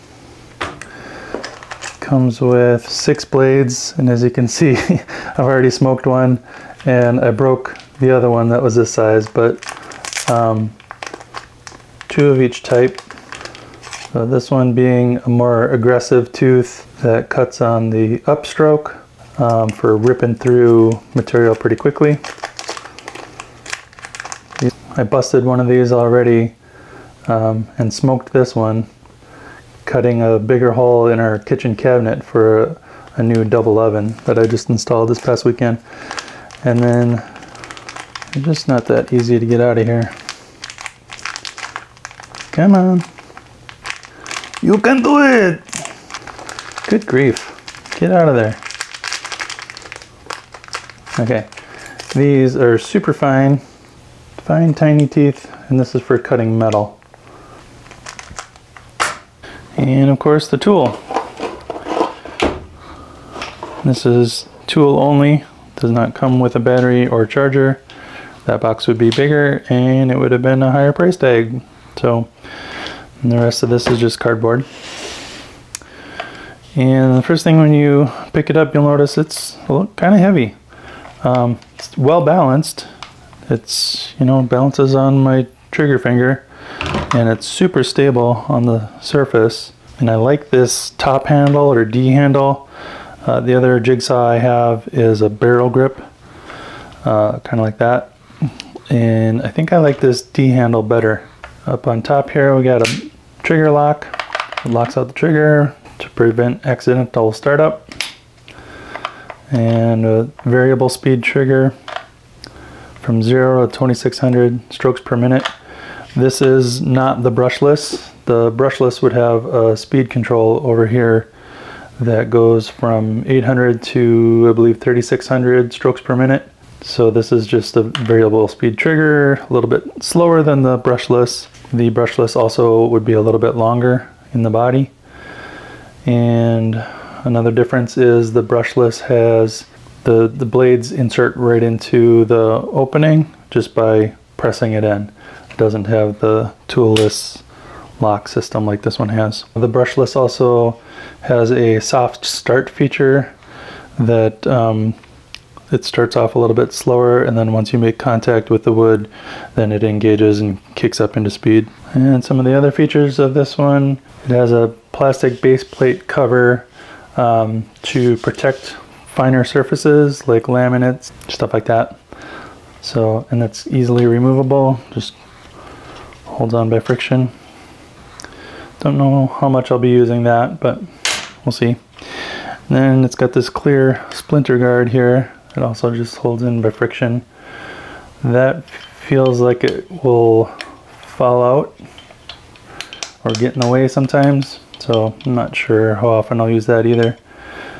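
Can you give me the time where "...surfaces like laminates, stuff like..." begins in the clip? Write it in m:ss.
2:49.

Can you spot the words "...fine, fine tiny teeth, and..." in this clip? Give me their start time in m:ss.
0:53.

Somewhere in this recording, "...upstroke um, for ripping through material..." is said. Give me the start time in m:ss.
0:18.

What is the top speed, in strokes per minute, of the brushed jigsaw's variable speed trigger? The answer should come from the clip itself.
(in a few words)
2600.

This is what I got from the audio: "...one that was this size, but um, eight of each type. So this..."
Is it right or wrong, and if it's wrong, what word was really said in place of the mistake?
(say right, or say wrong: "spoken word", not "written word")
wrong: "two", not "eight".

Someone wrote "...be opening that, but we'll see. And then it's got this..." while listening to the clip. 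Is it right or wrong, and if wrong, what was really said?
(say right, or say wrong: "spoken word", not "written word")
wrong: "using", not "opening".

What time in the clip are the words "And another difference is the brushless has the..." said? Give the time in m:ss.
2:16.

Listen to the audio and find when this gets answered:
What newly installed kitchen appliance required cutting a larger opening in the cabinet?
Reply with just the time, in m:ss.
0:33.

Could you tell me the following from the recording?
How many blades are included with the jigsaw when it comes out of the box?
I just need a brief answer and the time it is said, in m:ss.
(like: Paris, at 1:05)
6, at 0:02.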